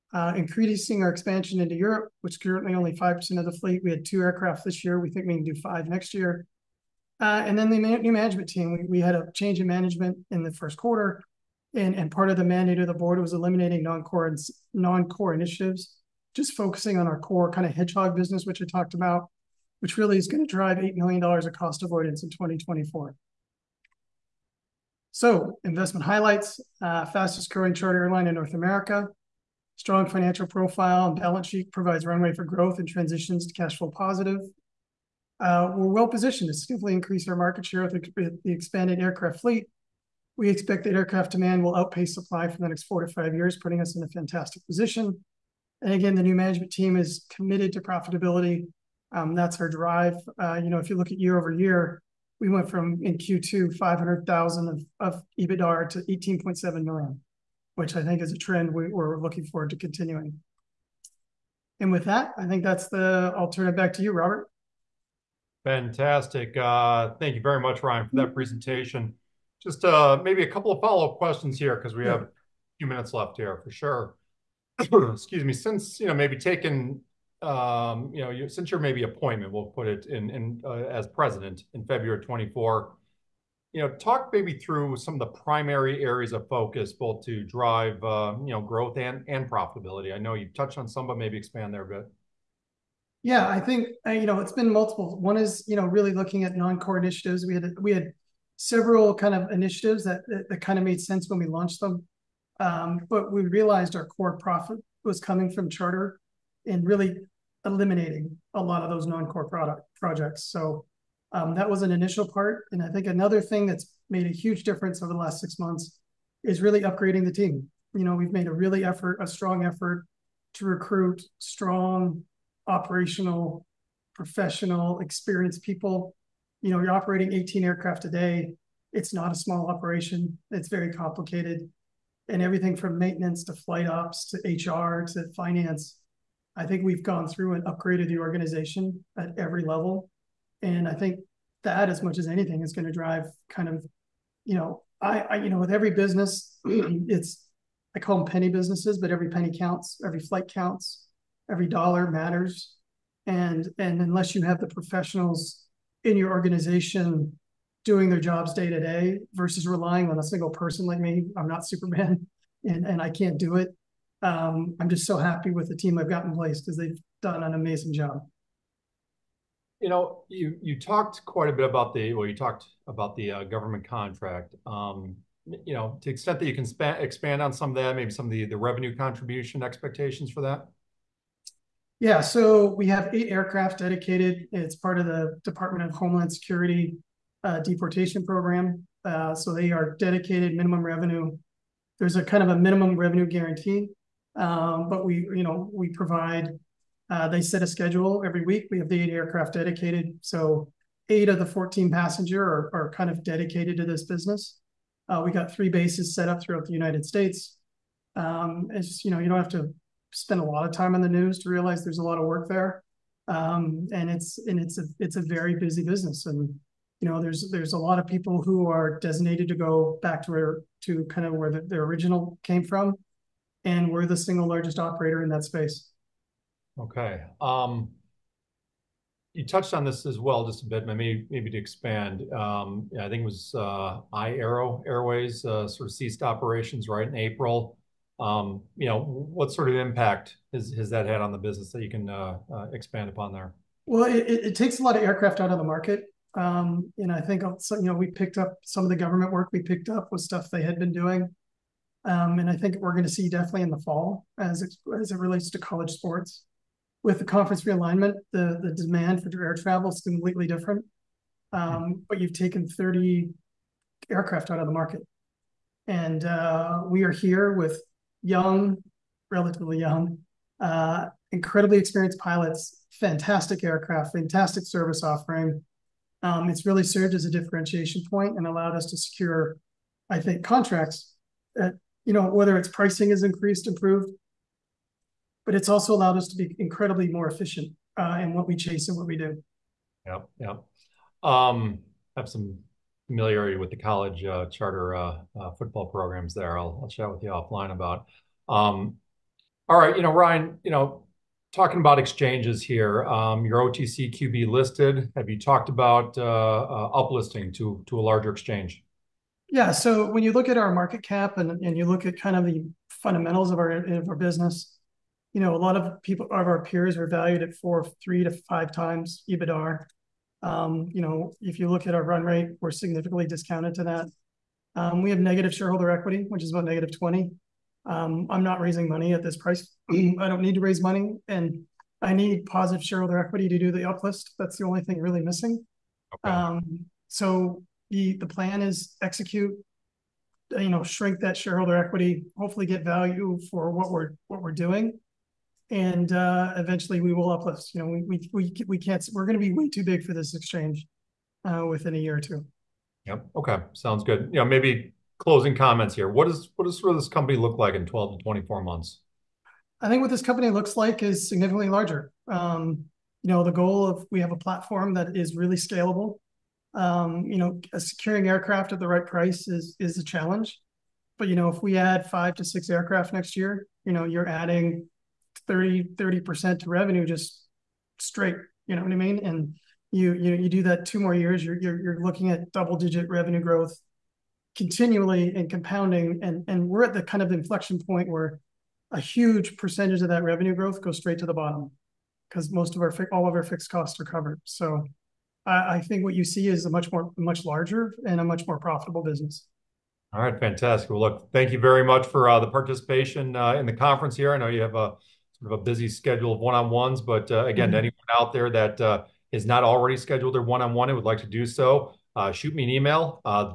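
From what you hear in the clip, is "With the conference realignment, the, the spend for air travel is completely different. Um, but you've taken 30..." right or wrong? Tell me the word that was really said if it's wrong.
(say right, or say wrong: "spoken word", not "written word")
wrong: "demand", not "spend".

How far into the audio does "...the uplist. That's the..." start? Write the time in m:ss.
5:33.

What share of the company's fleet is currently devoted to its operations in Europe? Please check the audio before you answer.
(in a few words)
5%.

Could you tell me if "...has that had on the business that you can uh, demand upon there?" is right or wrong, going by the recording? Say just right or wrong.
wrong.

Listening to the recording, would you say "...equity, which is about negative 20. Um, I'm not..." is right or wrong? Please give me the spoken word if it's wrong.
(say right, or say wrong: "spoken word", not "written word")
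right.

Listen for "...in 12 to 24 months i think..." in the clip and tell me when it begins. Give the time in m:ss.
5:57.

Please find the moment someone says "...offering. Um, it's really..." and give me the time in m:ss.
4:35.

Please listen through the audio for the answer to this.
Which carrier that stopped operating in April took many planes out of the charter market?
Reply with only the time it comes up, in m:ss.
3:54.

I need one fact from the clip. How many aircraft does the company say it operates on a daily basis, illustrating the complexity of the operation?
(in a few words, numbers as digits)
18.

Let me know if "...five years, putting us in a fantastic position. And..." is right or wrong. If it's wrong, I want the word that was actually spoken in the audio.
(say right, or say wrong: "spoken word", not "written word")
right.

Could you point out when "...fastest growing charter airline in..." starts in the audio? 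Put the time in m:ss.
0:27.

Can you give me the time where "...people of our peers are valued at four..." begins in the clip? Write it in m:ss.
5:16.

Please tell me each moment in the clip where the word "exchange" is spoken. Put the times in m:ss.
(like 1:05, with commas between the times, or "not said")
5:01, 5:08, 5:50.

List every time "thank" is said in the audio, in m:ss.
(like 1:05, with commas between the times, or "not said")
1:07, 6:41.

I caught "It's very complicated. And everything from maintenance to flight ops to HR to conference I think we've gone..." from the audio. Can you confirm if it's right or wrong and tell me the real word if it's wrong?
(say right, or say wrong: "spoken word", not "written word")
wrong: "finance", not "conference".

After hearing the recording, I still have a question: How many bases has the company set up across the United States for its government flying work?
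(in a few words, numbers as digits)
3.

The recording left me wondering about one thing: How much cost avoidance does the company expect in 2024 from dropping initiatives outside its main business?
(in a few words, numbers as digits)
$8 million.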